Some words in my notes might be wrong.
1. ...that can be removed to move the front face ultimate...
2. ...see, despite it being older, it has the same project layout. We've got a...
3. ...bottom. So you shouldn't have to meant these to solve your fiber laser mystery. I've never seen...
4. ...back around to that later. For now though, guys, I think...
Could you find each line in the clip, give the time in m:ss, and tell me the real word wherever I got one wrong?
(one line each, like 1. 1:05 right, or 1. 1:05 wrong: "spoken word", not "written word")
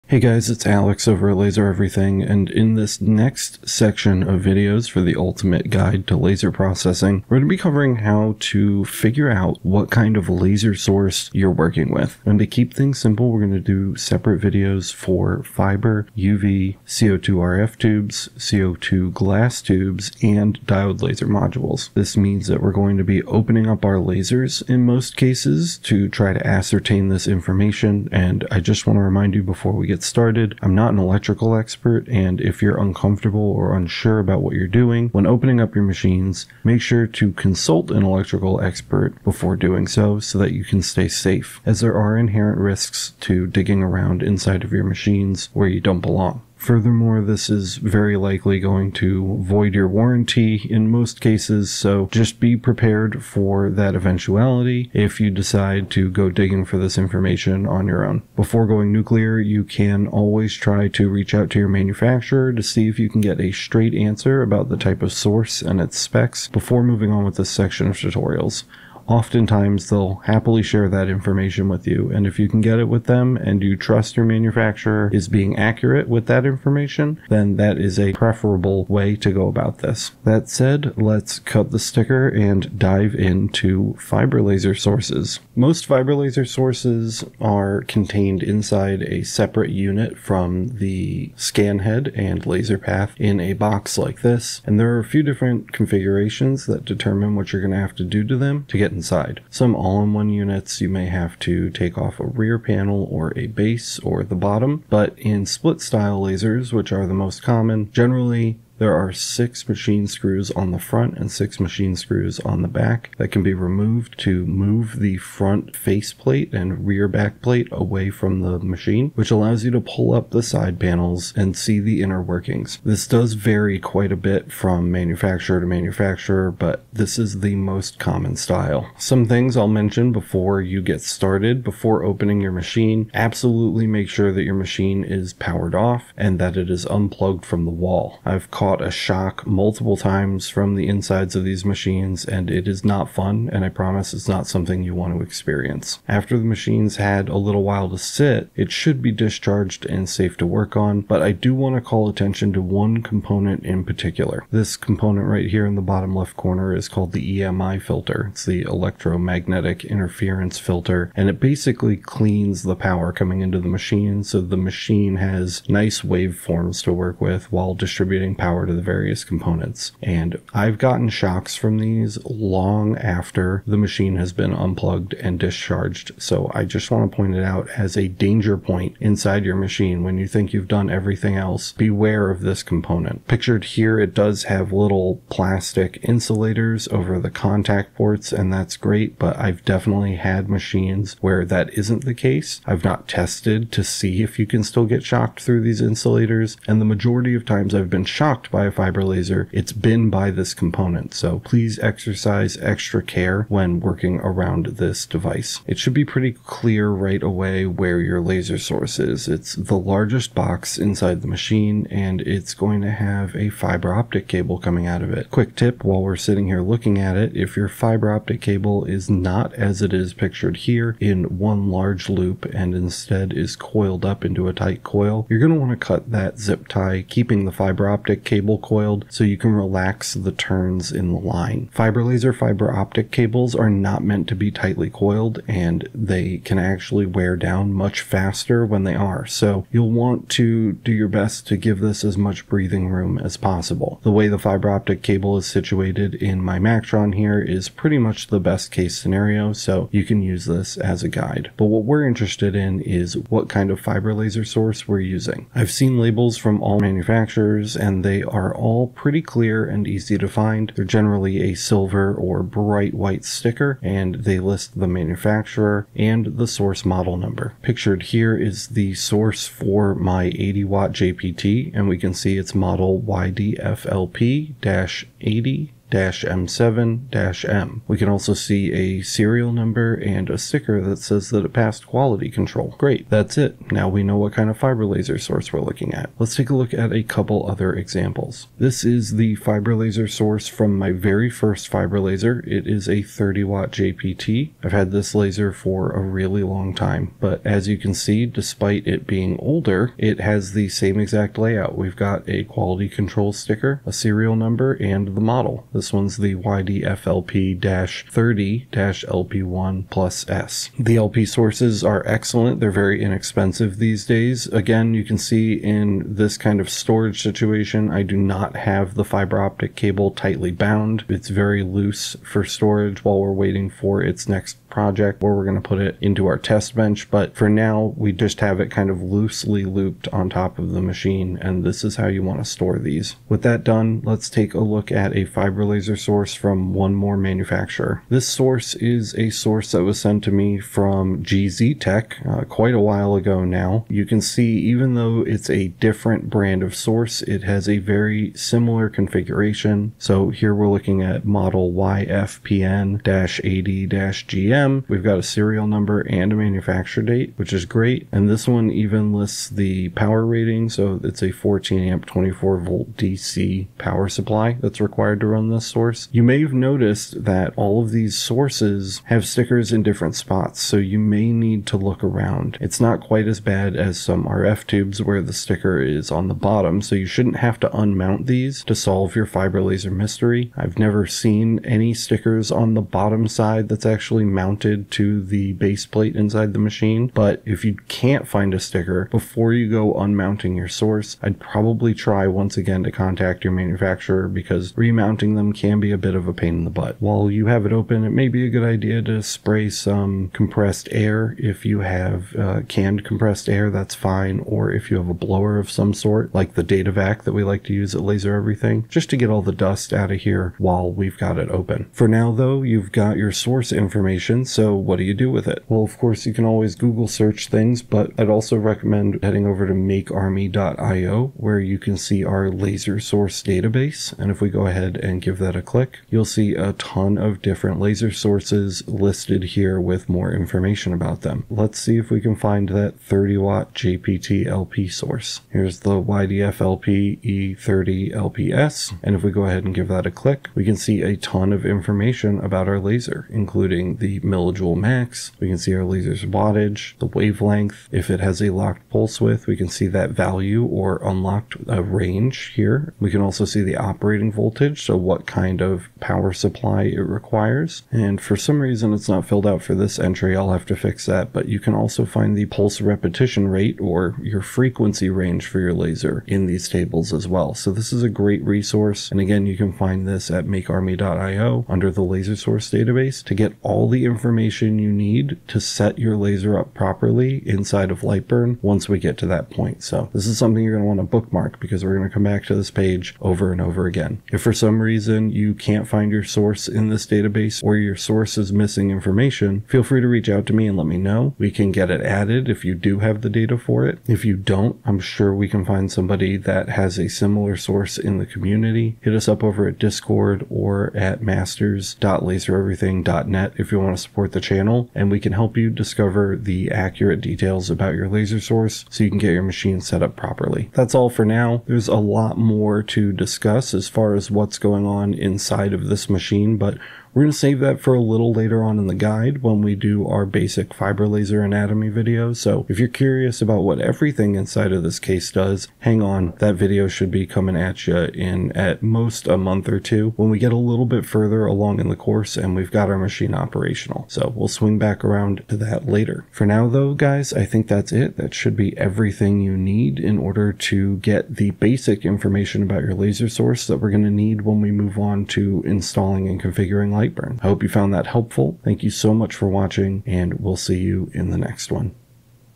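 1. 1:53 wrong: "plate", not "ultimate"
2. 4:57 wrong: "exact", not "project"
3. 6:16 wrong: "unmount", not "meant"
4. 8:54 right.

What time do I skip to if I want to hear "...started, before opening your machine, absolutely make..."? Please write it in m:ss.
2:11.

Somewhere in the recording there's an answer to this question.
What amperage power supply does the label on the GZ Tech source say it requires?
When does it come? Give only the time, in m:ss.
6:01.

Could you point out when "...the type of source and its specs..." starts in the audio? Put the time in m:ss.
1:04.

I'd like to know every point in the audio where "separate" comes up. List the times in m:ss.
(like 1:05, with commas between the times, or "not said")
0:13, 1:29.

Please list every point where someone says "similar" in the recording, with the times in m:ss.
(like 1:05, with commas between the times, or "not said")
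5:48, 8:17.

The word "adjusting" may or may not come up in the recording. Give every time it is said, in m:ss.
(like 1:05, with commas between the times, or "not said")
not said.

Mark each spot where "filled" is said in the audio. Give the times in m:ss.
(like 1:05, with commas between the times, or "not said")
7:39.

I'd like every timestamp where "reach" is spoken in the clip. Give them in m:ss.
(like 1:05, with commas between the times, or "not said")
1:01, 8:10.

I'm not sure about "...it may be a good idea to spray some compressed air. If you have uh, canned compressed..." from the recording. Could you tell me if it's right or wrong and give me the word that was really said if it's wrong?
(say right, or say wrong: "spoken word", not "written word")
right.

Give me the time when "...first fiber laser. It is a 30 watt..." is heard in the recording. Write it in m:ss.
4:51.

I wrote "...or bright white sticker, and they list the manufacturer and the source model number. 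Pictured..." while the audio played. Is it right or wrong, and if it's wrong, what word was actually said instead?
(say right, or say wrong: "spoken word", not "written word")
right.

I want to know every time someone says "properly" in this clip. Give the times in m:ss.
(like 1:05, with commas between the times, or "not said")
7:56, 8:30.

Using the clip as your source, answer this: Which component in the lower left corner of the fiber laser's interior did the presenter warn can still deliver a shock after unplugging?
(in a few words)
EMI filter.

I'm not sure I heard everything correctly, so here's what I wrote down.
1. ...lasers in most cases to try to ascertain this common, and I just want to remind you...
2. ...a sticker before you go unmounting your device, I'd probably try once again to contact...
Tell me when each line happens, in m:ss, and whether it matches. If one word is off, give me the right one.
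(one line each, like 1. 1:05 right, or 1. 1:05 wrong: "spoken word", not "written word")
1. 0:23 wrong: "information", not "common"
2. 6:28 wrong: "source", not "device".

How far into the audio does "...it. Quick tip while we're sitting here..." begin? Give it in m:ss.
3:35.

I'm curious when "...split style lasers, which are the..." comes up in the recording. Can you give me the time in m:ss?
1:45.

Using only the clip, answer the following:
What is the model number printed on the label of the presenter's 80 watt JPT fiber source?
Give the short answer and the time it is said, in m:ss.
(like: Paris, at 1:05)
YDFLP 80 M7-M, at 4:33.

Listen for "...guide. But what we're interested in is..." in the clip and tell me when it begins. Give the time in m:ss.
4:11.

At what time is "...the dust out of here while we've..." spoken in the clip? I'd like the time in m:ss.
6:49.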